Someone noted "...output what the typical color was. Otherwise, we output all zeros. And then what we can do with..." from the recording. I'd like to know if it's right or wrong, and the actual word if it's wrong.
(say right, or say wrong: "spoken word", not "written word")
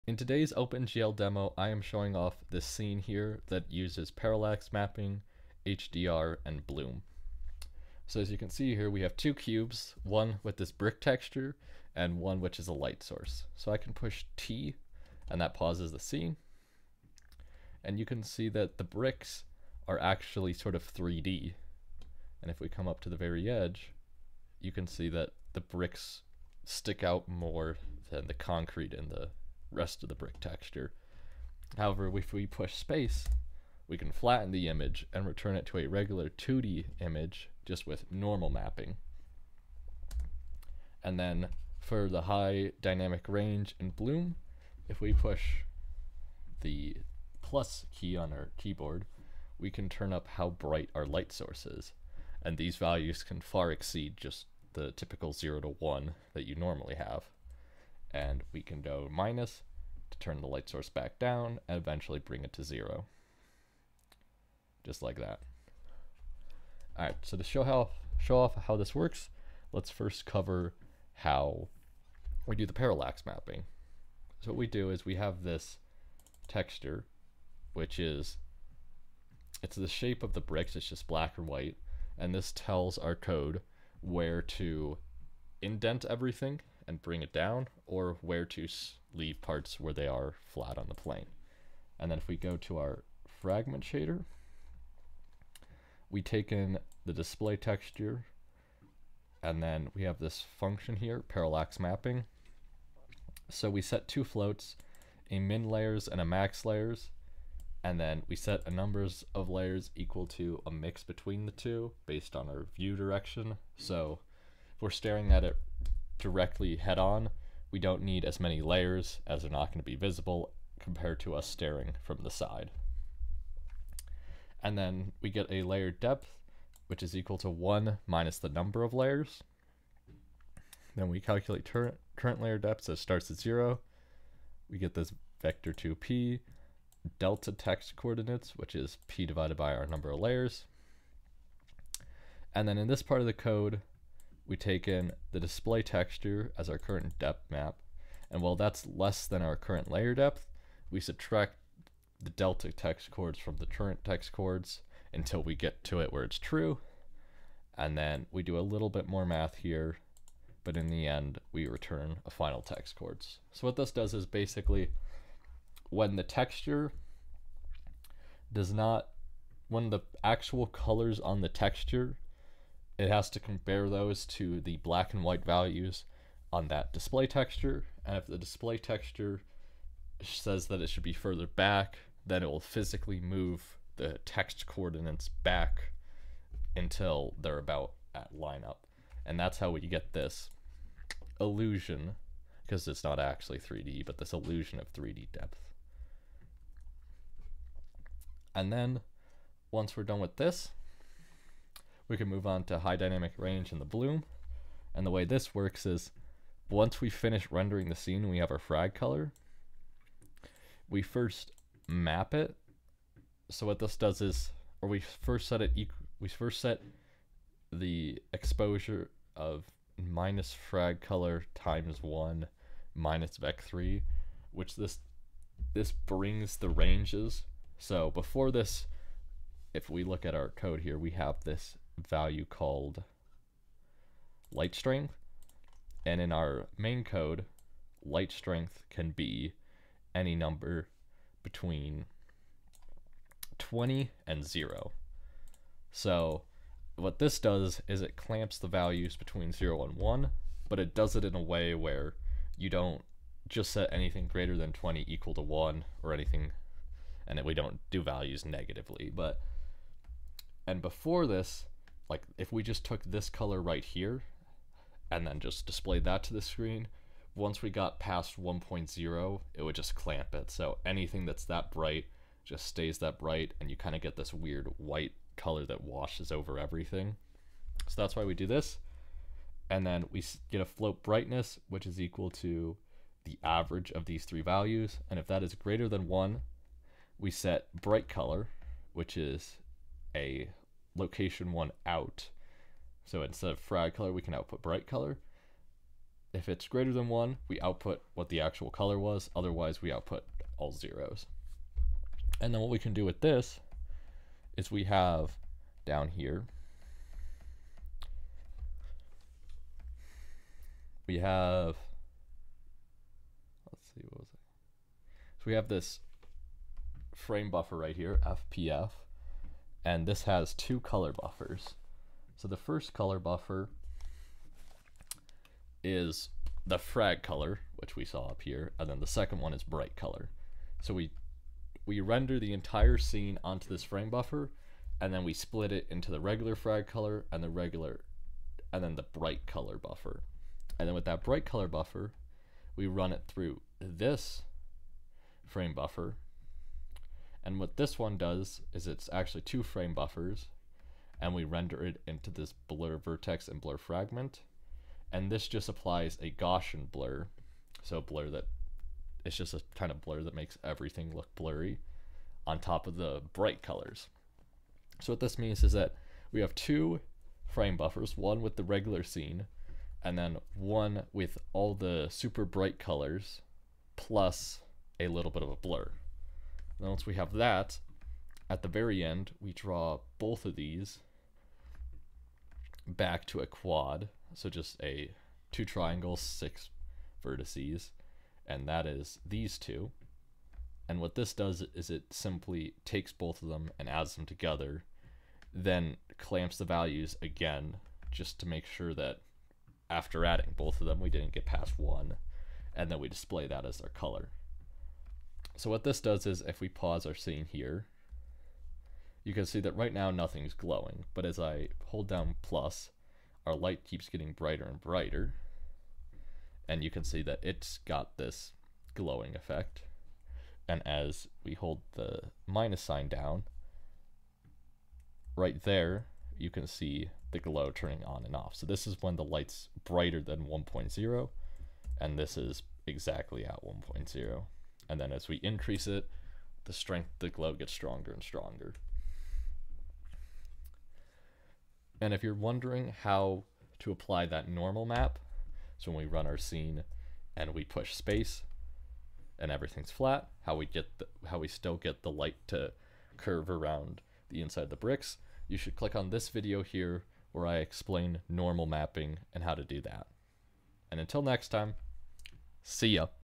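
wrong: "actual", not "typical".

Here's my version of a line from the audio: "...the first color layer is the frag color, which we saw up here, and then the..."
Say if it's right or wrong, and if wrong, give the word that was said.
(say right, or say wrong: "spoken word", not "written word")
wrong: "buffer", not "layer".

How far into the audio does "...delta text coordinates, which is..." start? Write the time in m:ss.
2:17.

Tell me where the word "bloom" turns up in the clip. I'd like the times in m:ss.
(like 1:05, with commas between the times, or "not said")
0:06, 0:43, 3:23.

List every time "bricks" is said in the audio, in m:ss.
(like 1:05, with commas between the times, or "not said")
0:10, 0:18, 0:25, 0:30, 1:20, 7:34.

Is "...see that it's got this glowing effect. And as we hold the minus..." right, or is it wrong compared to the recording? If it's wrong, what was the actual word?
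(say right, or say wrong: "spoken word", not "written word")
right.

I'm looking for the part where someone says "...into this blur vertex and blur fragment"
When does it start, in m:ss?
5:52.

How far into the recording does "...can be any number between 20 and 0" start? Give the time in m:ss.
3:58.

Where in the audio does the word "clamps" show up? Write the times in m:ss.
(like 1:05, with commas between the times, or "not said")
4:08, 4:29, 6:36.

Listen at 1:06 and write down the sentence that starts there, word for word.
All right, so to show, how, show off how this works, let's first cover how we do the parallax mapping.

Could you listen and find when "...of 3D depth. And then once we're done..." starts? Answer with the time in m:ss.
3:14.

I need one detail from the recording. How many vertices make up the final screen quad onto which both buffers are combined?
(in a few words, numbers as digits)
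6.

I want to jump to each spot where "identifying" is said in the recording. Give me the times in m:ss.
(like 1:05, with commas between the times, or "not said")
not said.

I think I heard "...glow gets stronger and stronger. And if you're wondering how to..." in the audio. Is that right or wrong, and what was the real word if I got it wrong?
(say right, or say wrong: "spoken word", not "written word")
right.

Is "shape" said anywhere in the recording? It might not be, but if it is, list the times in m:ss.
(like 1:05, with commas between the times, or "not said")
1:19.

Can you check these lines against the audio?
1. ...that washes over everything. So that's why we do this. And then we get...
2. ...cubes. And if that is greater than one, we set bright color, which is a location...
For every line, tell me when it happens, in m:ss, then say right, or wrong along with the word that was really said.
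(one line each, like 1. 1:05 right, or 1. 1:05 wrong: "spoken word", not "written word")
1. 4:35 right
2. 4:44 wrong: "values", not "cubes".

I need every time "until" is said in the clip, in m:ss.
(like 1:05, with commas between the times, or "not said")
2:35, 3:06, 7:40.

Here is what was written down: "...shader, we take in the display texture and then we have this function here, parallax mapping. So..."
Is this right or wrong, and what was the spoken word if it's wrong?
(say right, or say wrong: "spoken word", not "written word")
right.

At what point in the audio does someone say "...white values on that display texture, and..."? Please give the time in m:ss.
2:55.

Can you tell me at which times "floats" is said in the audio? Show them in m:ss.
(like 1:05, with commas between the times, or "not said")
1:44, 4:40.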